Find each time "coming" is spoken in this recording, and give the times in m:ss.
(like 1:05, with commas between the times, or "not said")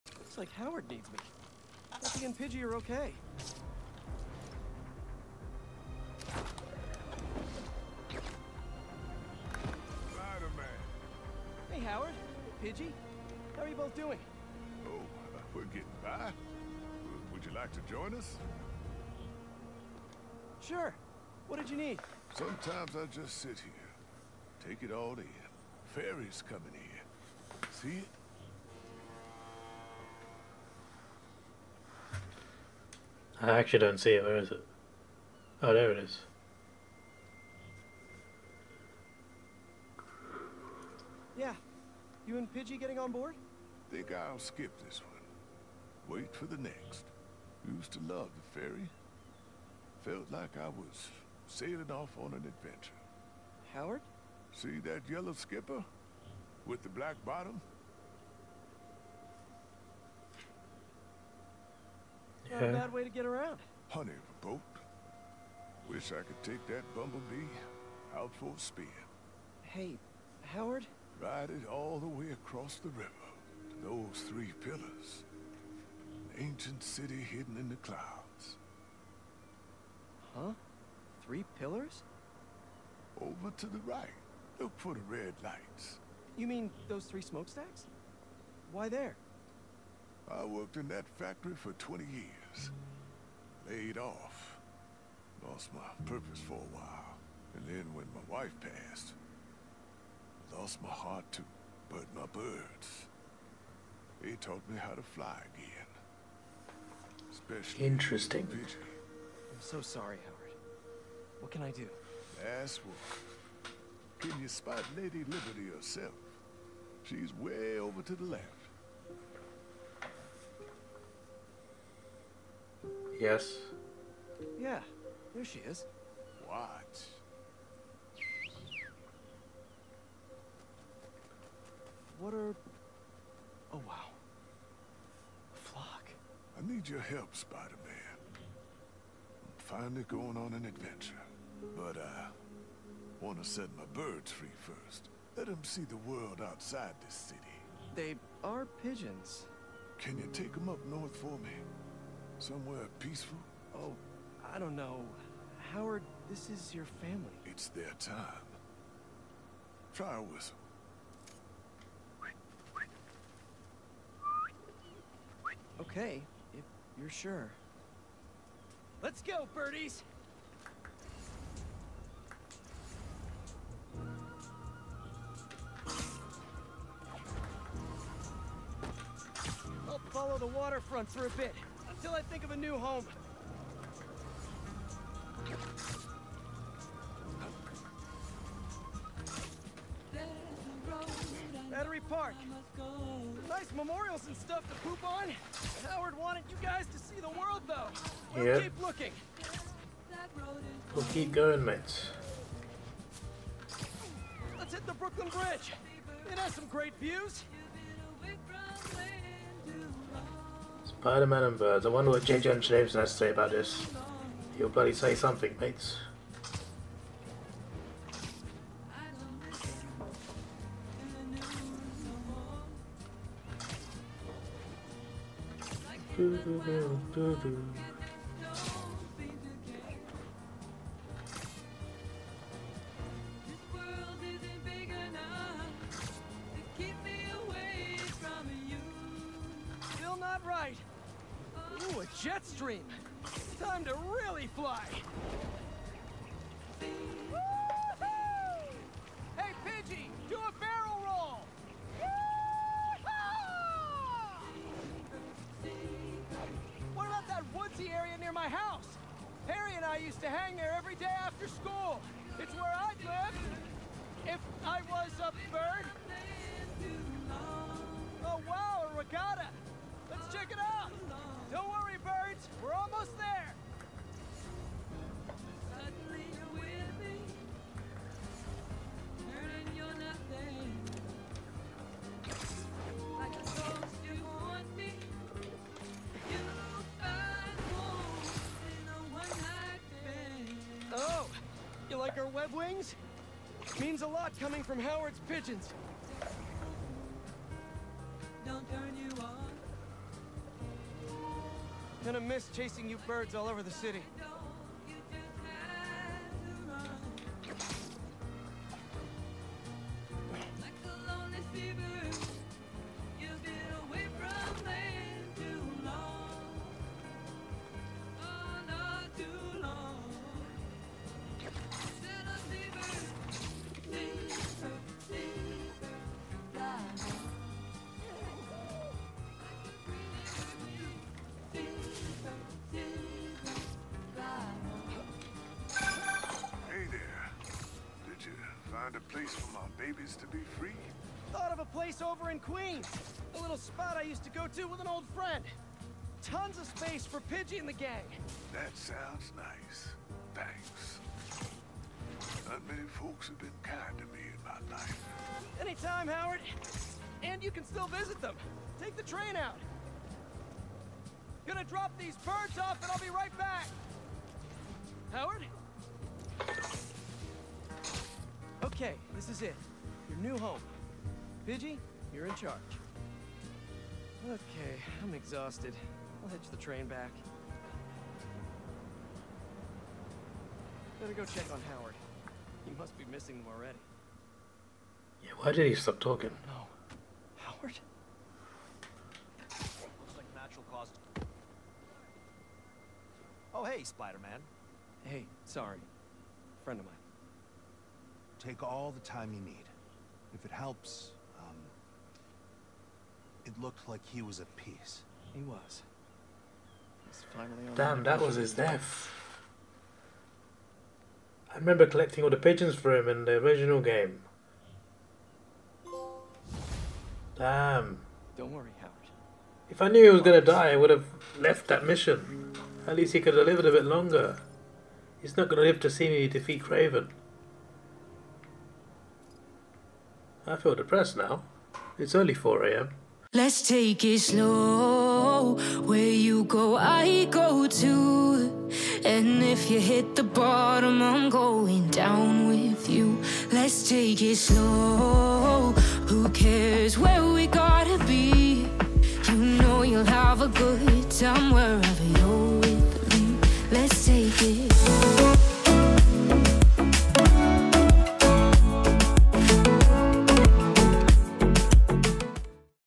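0:26, 4:54.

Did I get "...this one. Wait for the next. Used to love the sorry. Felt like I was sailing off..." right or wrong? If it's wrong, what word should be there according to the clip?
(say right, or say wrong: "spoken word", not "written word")
wrong: "ferry", not "sorry".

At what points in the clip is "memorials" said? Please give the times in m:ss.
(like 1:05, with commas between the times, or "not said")
3:13.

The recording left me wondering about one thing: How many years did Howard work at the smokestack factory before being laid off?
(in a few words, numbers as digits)
20.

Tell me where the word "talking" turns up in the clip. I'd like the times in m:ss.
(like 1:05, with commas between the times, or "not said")
6:25.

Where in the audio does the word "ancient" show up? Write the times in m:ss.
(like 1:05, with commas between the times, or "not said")
1:16.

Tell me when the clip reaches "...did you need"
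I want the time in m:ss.
0:21.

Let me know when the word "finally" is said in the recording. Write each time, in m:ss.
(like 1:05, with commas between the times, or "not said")
2:19, 6:47.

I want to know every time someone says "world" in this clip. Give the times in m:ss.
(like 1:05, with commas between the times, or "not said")
2:25, 3:17.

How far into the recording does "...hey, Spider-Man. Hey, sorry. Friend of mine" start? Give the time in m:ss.
6:33.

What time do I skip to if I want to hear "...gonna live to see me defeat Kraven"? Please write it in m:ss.
7:05.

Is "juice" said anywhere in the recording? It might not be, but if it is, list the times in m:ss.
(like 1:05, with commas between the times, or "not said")
not said.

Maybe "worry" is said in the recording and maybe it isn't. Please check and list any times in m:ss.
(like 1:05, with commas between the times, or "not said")
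4:31, 6:58.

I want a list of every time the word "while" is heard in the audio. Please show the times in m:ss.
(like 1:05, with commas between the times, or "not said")
1:36.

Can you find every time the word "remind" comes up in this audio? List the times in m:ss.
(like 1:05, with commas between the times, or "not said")
not said.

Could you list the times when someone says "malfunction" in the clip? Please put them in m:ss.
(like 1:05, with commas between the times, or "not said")
not said.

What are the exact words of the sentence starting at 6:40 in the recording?
If it helps, um, it looked like he was at peace.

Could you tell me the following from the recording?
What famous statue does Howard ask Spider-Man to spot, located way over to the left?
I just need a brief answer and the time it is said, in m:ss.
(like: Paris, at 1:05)
Lady Liberty, at 1:54.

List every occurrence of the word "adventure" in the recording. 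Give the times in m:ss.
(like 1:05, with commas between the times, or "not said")
0:52, 2:20.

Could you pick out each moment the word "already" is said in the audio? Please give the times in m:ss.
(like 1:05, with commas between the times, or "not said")
6:23.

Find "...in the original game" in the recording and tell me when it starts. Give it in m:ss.
6:53.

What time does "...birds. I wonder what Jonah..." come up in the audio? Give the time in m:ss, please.
3:31.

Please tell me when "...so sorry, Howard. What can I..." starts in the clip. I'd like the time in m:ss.
1:49.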